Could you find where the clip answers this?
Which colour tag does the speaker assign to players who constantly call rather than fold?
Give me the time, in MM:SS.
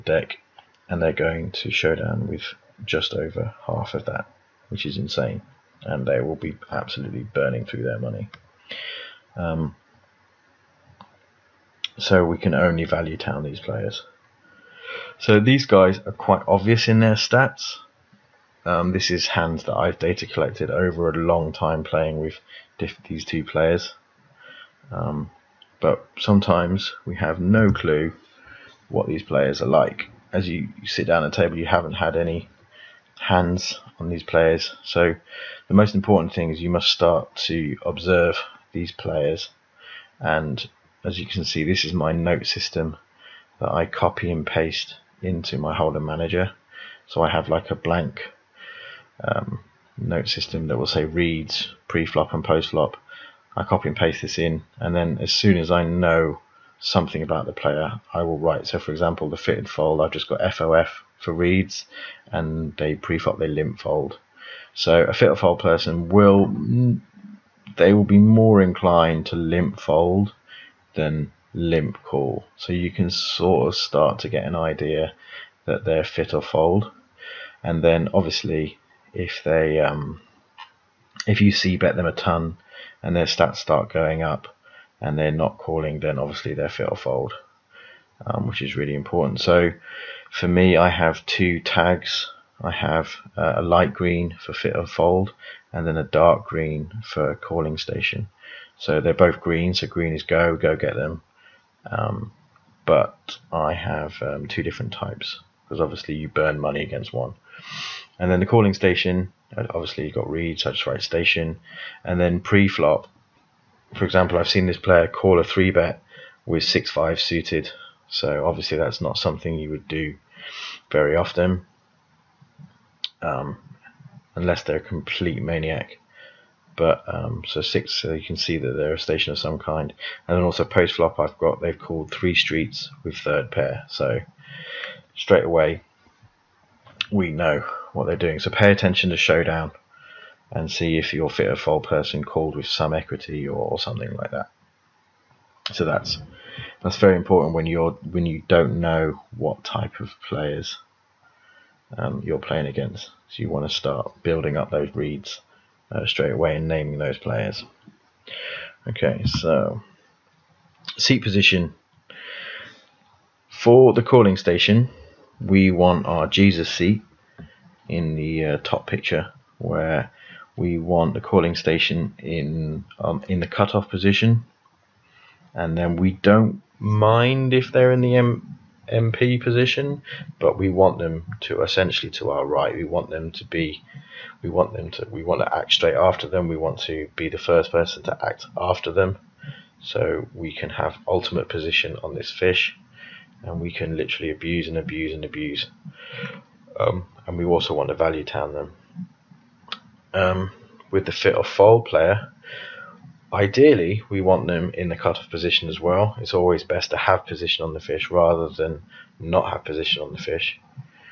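01:36.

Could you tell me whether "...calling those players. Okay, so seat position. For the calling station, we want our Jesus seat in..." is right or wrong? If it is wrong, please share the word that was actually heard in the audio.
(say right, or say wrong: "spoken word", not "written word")
wrong: "naming", not "calling".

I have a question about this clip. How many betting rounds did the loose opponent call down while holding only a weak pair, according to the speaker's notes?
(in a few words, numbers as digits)
3.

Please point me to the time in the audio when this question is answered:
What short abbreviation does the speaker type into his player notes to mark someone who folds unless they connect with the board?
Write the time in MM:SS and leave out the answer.
01:00.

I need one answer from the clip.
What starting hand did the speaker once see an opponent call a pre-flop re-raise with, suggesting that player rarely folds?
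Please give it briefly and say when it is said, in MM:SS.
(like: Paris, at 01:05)
6-5 suited, at 01:56.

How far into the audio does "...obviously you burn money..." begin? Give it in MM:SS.
01:45.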